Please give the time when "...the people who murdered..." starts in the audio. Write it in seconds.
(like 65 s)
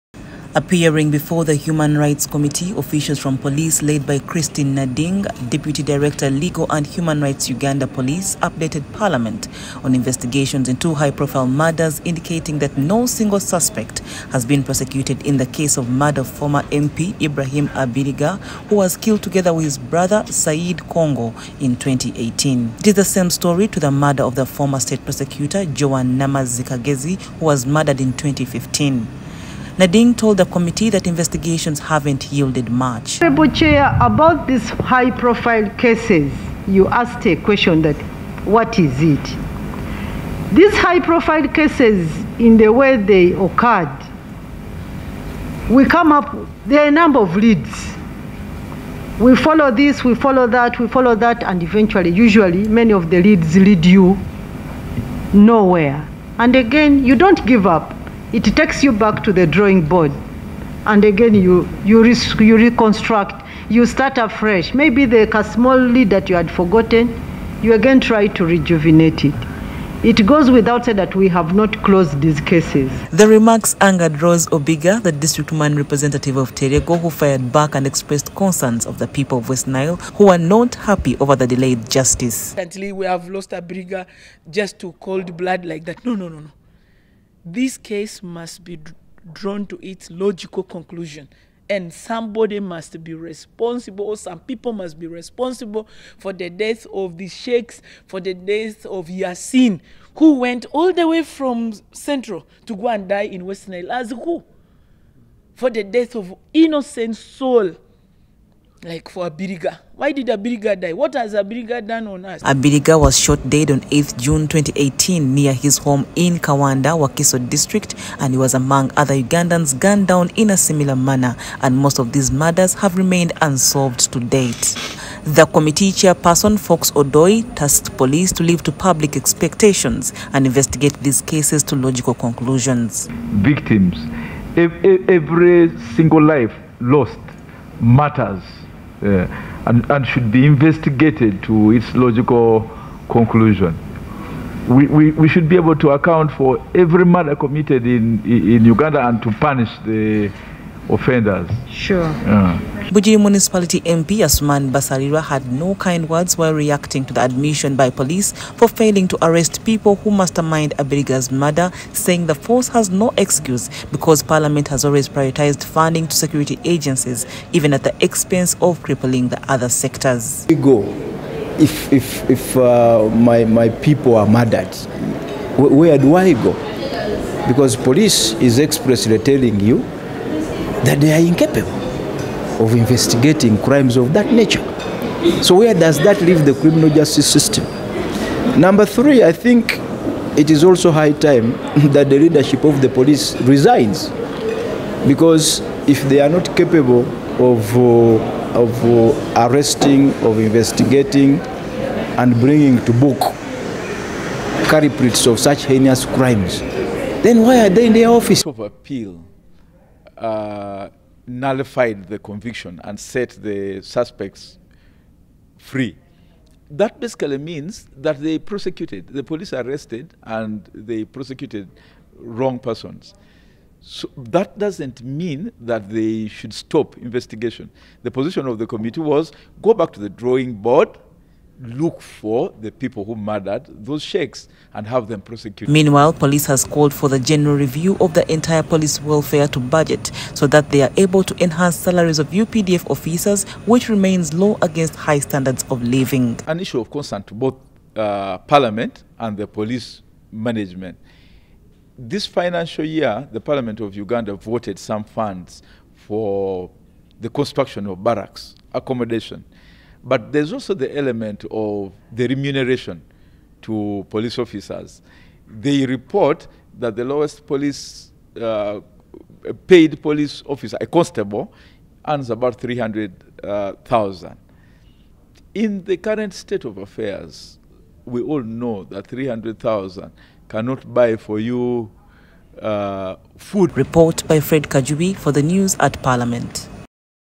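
232 s.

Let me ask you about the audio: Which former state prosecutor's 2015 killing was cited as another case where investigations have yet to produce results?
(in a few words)
Joan Namaz.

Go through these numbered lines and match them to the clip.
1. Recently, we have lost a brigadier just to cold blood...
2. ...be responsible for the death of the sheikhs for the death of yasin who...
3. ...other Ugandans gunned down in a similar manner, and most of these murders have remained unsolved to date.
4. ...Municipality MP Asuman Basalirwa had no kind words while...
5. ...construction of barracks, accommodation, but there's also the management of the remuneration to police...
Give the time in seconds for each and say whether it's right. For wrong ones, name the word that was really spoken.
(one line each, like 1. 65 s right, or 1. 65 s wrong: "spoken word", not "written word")
1. 82 s right
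2. 94 s right
3. 118 s right
4. 153 s right
5. 257 s wrong: "element", not "management".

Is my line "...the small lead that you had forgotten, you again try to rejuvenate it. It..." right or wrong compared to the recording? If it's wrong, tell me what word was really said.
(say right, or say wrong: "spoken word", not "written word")
right.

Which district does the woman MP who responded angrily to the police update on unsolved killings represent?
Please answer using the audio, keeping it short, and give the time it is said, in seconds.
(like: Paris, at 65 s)
Terego, at 76 s.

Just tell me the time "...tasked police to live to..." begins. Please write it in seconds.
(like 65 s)
127 s.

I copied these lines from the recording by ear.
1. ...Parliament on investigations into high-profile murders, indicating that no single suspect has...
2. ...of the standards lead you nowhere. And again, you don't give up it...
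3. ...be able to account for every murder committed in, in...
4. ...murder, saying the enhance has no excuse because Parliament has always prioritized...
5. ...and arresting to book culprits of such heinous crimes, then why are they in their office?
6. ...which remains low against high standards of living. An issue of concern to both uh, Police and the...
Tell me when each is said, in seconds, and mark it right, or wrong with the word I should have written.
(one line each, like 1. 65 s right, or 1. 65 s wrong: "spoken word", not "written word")
1. 8 s right
2. 52 s wrong: "leads", not "standards"
3. 145 s right
4. 161 s wrong: "force", not "enhance"
5. 202 s wrong: "bringing", not "arresting"
6. 243 s wrong: "Parliament", not "Police".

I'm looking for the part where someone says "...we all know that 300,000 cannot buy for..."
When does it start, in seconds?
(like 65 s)
278 s.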